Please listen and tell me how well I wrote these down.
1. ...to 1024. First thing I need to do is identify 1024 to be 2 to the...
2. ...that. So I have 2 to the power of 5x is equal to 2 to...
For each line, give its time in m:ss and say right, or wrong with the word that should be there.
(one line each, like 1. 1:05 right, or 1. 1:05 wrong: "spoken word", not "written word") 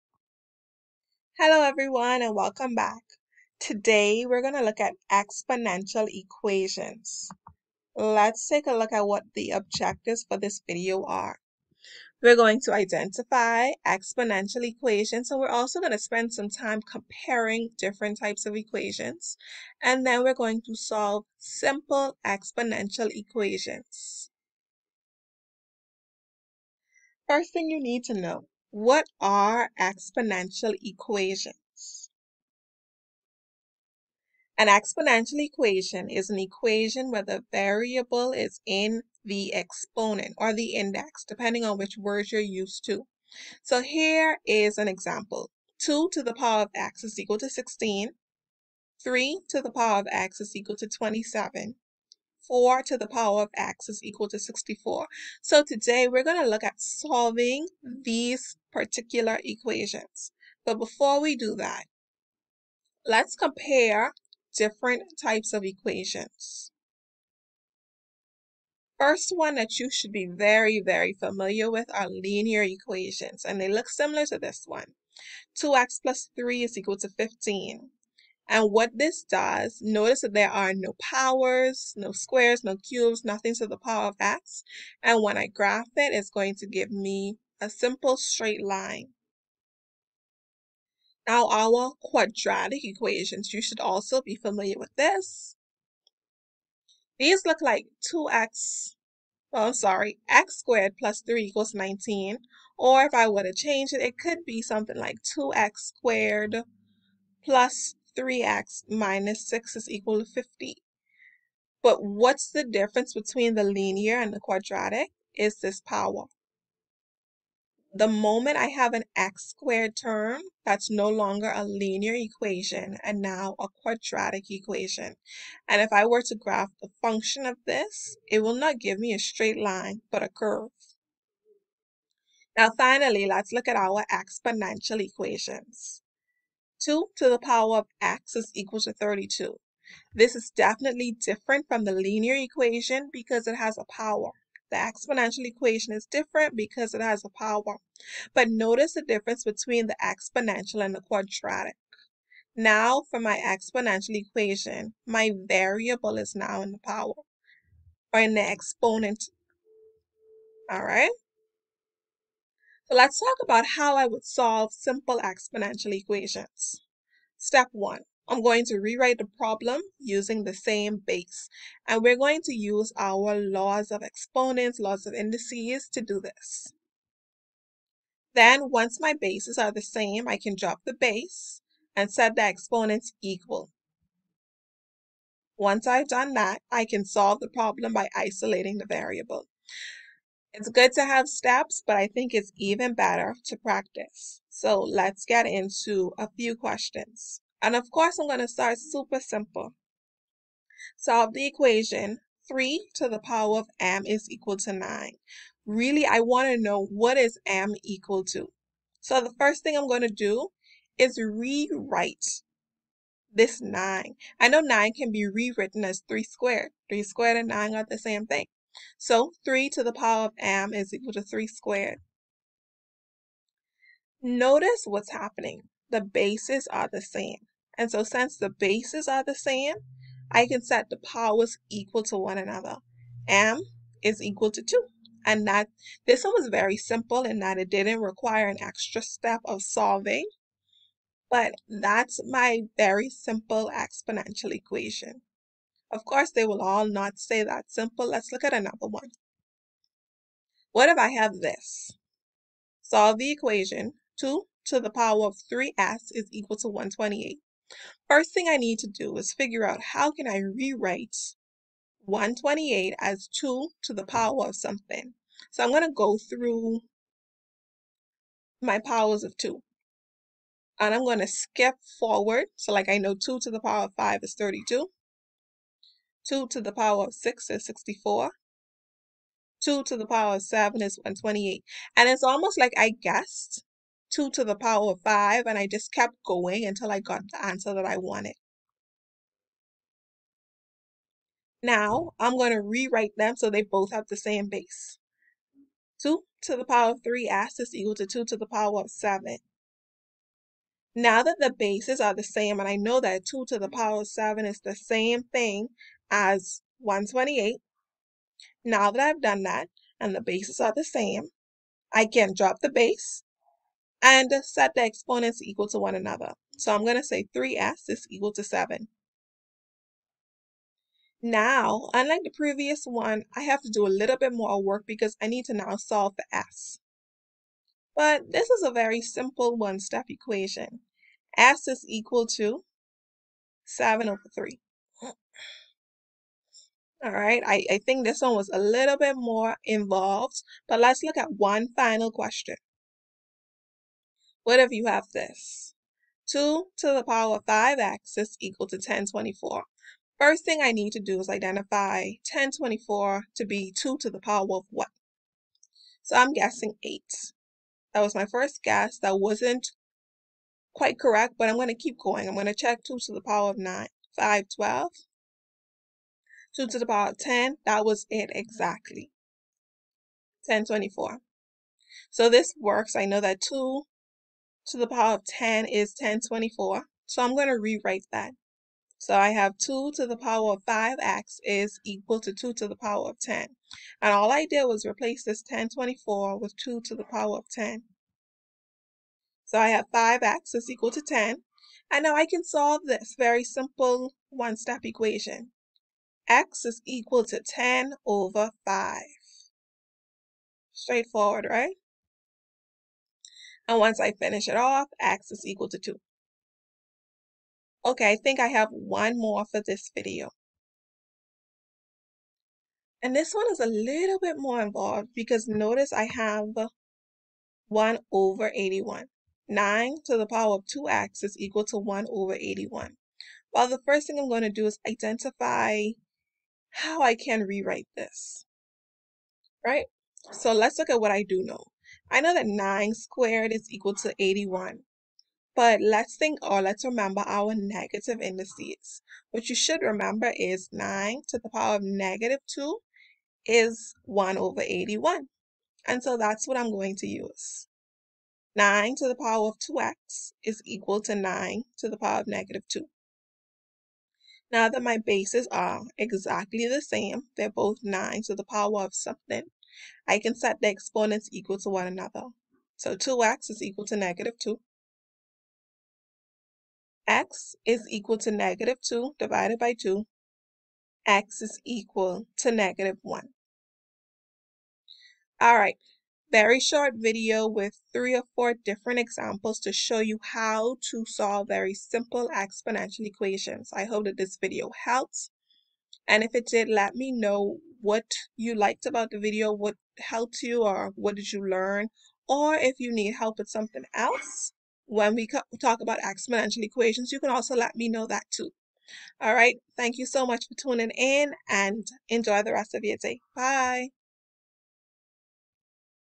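1. 5:48 right
2. 6:18 right.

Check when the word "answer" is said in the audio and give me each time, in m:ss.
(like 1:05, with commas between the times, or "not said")
4:47.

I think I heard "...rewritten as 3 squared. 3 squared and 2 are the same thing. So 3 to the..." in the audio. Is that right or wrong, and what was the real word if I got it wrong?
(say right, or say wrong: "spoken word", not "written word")
wrong: "9", not "2".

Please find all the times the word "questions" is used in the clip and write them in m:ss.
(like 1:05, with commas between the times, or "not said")
3:16, 5:42.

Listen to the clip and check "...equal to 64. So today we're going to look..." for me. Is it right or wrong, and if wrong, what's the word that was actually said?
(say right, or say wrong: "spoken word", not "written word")
right.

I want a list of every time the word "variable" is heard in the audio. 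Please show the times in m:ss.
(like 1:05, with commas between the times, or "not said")
0:37, 2:35, 3:08.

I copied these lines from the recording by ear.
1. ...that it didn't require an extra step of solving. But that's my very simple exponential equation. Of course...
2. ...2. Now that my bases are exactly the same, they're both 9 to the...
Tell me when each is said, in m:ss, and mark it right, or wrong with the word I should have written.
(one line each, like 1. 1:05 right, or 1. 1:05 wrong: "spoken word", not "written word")
1. 3:57 right
2. 7:32 right.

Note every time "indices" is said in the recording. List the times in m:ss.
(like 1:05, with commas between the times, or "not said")
2:55, 7:18.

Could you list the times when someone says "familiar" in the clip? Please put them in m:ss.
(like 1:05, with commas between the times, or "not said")
1:11, 1:34.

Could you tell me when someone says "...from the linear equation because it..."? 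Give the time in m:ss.
2:21.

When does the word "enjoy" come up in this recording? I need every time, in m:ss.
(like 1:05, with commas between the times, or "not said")
8:22.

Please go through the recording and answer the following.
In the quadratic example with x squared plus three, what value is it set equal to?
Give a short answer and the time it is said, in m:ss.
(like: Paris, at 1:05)
19, at 1:41.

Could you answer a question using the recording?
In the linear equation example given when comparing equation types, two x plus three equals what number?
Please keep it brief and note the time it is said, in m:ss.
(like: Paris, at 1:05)
15, at 1:17.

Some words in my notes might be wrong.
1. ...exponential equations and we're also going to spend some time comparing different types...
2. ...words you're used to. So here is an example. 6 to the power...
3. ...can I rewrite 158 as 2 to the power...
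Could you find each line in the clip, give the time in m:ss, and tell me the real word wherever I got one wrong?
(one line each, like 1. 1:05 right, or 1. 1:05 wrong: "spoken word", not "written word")
1. 0:13 right
2. 0:41 wrong: "2", not "6"
3. 4:20 wrong: "128", not "158".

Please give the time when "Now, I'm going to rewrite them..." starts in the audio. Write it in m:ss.
4:51.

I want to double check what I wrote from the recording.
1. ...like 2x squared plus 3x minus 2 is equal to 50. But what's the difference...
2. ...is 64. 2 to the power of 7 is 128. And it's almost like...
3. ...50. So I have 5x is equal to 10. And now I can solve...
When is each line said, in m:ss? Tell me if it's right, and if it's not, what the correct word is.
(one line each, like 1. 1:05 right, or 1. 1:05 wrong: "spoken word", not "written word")
1. 1:44 wrong: "6", not "2"
2. 4:37 right
3. 6:27 wrong: "10", not "50".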